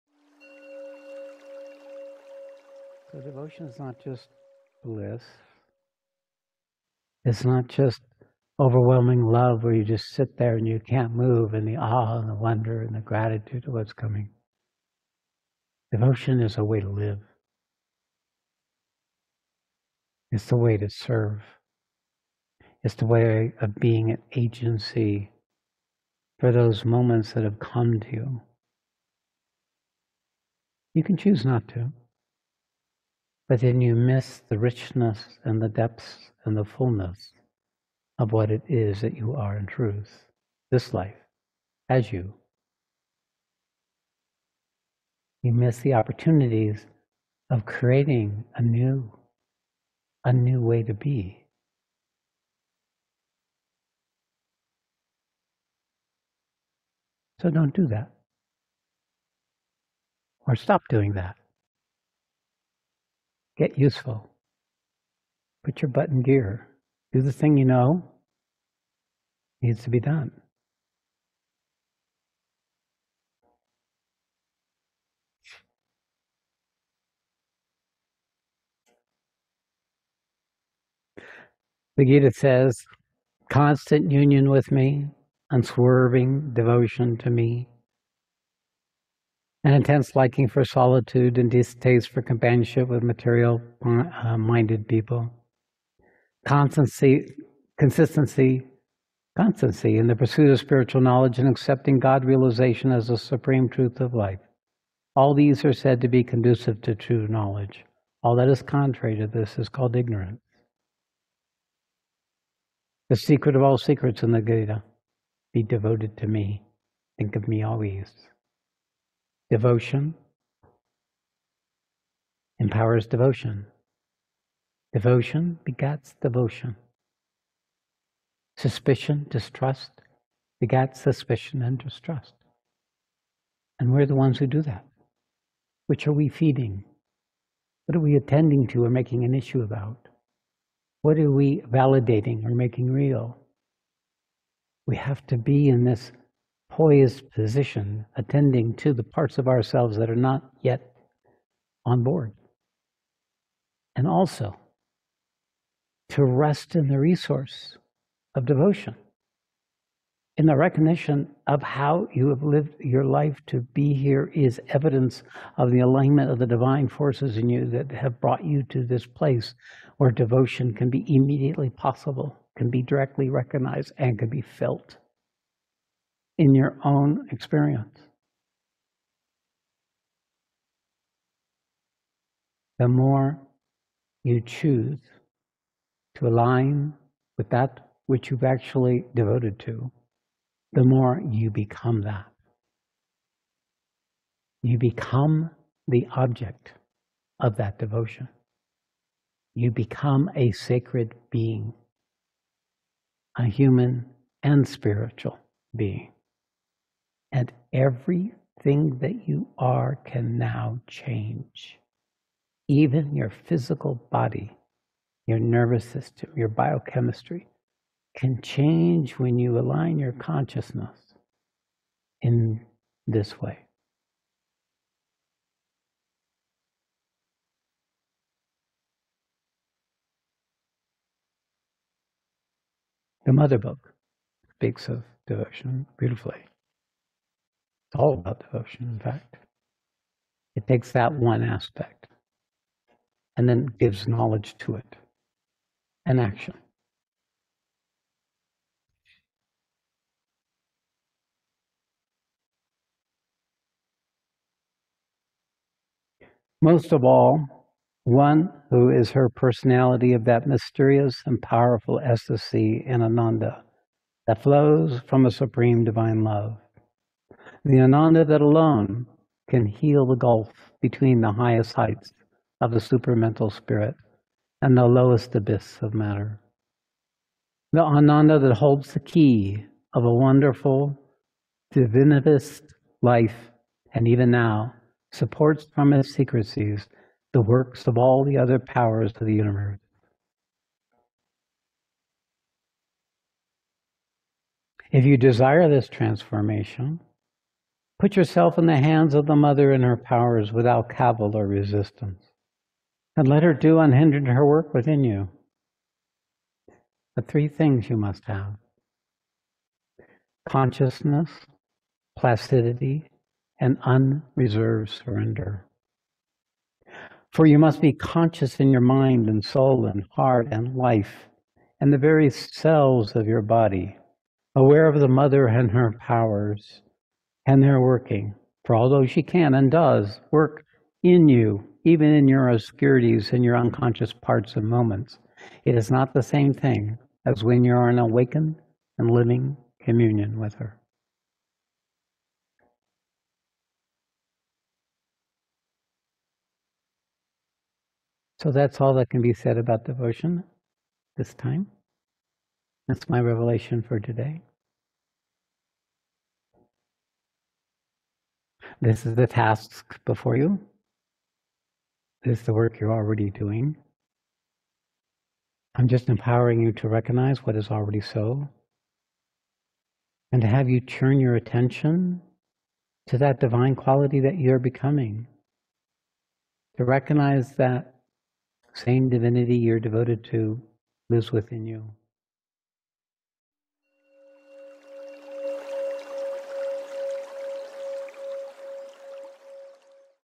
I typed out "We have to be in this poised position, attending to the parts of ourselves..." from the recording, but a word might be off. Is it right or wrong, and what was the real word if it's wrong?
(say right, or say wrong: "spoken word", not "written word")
right.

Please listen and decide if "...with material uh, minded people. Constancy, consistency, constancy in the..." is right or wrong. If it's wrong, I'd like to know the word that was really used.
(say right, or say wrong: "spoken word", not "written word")
right.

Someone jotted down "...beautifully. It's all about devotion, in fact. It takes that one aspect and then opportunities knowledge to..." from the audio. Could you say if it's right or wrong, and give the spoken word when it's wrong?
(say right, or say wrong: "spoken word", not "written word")
wrong: "gives", not "opportunities".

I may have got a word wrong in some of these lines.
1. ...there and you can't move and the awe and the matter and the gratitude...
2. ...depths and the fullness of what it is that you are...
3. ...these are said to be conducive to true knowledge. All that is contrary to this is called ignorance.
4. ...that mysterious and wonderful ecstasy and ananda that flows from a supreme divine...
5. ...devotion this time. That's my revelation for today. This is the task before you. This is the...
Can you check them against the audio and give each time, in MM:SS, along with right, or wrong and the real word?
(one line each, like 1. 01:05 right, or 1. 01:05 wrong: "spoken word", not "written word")
1. 00:10 wrong: "wonder", not "matter"
2. 00:35 right
3. 01:45 right
4. 04:20 wrong: "powerful", not "wonderful"
5. 05:49 right.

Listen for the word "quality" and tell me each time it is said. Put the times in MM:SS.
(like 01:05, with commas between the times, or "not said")
06:13.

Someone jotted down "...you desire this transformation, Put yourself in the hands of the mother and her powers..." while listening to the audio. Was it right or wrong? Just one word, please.
right.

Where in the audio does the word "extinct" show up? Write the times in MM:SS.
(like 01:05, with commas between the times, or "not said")
not said.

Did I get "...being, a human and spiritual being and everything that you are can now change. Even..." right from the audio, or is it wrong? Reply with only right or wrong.
right.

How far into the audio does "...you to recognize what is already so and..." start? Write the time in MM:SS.
06:06.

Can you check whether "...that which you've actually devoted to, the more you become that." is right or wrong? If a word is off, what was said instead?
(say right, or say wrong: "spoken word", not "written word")
right.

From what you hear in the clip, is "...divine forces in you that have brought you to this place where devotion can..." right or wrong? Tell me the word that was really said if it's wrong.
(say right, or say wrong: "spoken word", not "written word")
right.